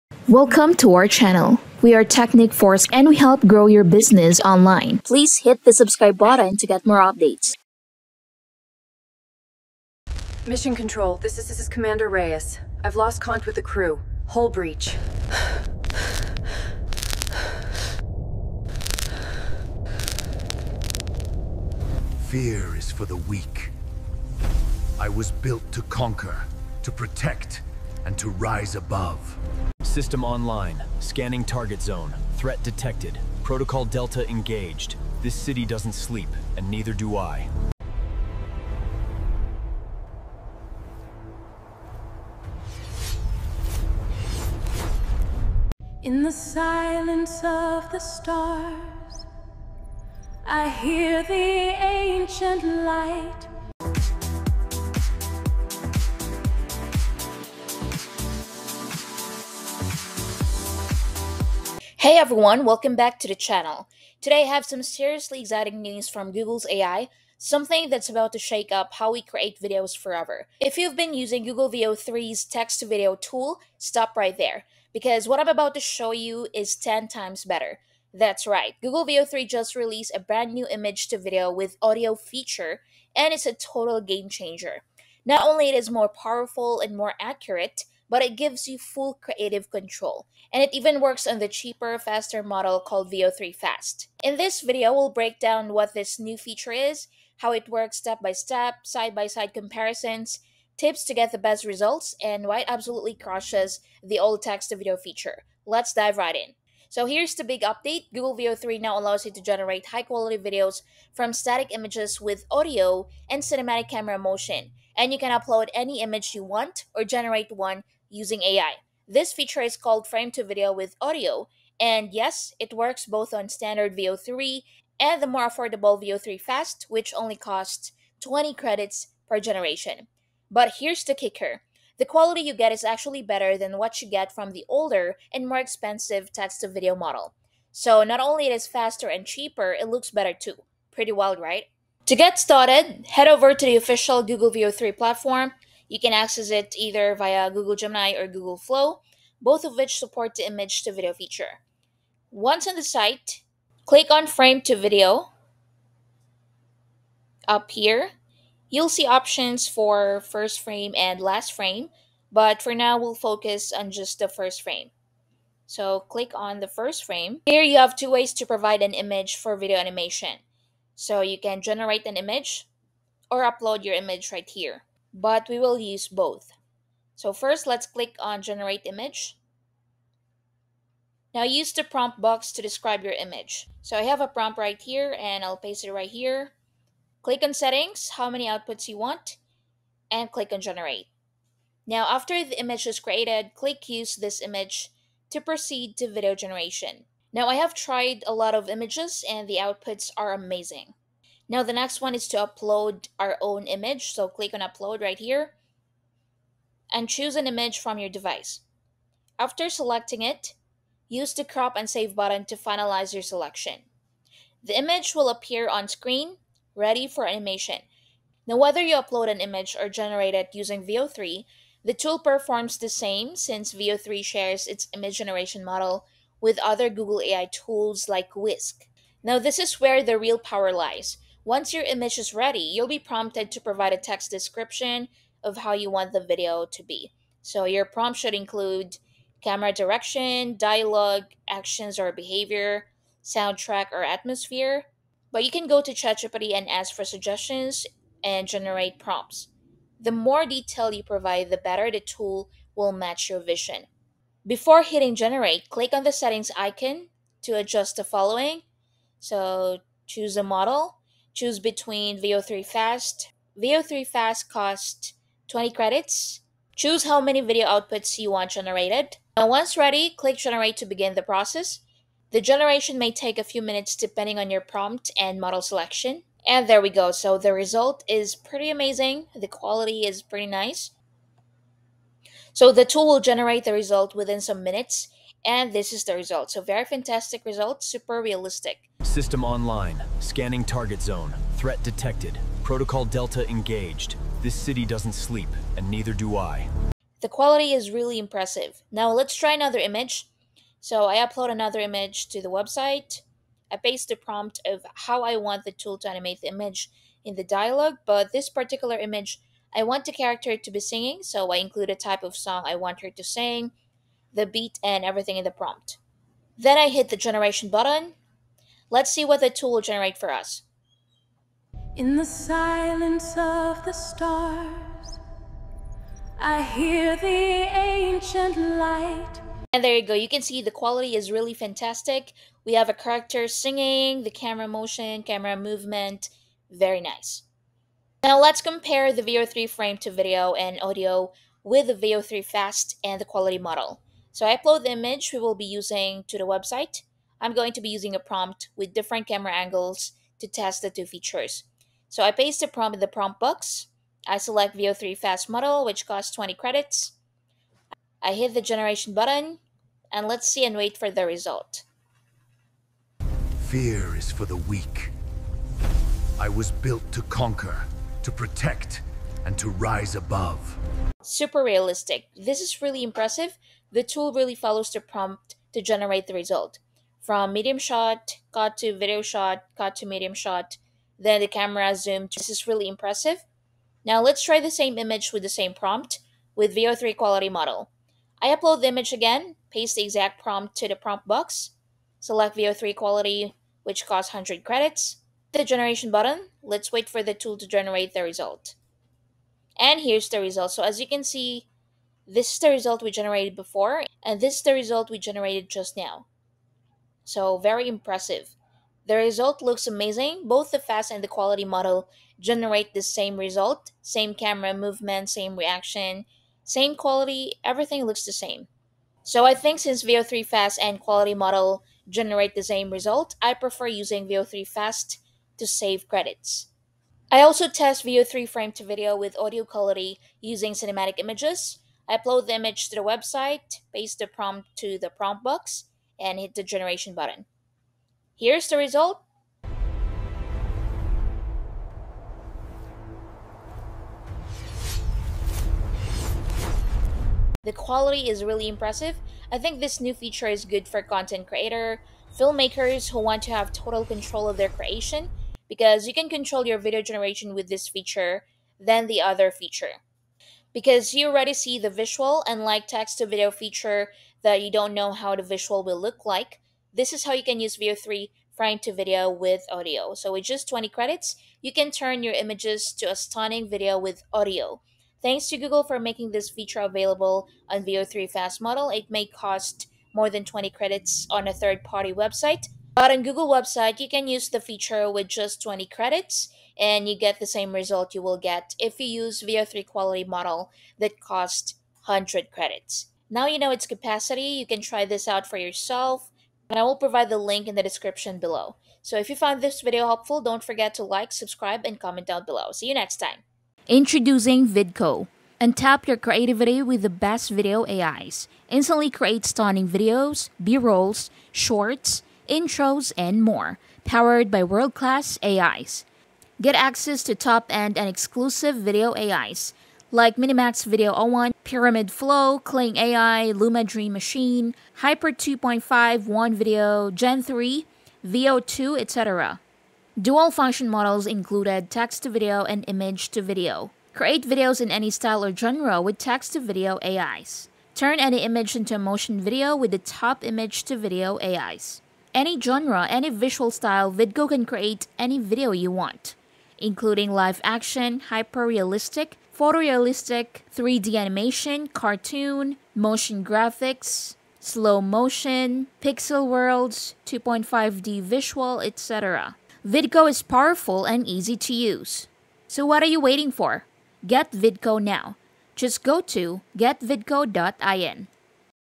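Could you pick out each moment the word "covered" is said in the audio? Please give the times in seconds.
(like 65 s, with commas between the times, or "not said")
not said.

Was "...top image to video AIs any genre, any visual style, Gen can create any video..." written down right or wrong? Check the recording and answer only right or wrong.
wrong.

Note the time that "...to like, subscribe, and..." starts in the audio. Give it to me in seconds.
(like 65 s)
500 s.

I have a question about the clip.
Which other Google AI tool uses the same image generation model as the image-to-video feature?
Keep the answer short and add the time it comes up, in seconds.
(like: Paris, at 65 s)
Whisk, at 228 s.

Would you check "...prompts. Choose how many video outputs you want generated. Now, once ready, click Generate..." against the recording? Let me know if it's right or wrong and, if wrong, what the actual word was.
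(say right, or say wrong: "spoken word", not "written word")
wrong: "credits", not "prompts".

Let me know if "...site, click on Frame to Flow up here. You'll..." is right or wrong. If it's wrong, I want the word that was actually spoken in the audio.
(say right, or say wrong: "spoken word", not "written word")
wrong: "Video", not "Flow".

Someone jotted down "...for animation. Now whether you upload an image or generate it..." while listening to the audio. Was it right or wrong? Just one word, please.
right.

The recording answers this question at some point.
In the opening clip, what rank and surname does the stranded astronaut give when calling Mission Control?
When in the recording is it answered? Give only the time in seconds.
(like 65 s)
11 s.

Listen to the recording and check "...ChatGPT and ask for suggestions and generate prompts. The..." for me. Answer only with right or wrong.
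right.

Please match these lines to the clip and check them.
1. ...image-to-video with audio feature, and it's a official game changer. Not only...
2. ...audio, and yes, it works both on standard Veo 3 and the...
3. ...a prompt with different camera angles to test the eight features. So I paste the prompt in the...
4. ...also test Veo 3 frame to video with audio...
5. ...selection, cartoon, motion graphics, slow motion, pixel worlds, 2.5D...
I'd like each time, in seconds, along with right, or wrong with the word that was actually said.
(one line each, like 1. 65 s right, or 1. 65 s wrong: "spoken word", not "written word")
1. 80 s wrong: "total", not "official"
2. 121 s right
3. 348 s wrong: "two", not "eight"
4. 427 s right
5. 551 s wrong: "animation", not "selection".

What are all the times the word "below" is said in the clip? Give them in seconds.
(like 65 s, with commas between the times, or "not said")
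498 s, 502 s.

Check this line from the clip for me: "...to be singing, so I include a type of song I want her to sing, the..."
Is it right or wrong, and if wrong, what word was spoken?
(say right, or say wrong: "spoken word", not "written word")
right.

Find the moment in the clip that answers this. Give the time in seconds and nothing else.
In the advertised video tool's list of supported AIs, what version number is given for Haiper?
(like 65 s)
524 s.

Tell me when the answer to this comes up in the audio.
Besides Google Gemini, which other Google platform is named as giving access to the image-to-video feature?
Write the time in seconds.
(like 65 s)
148 s.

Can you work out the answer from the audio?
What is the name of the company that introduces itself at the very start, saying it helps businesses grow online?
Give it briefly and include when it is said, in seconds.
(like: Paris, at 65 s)
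Teknikforce, at 2 s.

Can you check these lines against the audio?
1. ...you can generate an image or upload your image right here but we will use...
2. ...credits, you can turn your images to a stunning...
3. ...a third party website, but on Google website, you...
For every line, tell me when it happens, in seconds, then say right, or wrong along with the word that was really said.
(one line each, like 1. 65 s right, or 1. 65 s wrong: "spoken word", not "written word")
1. 171 s right
2. 470 s right
3. 481 s right.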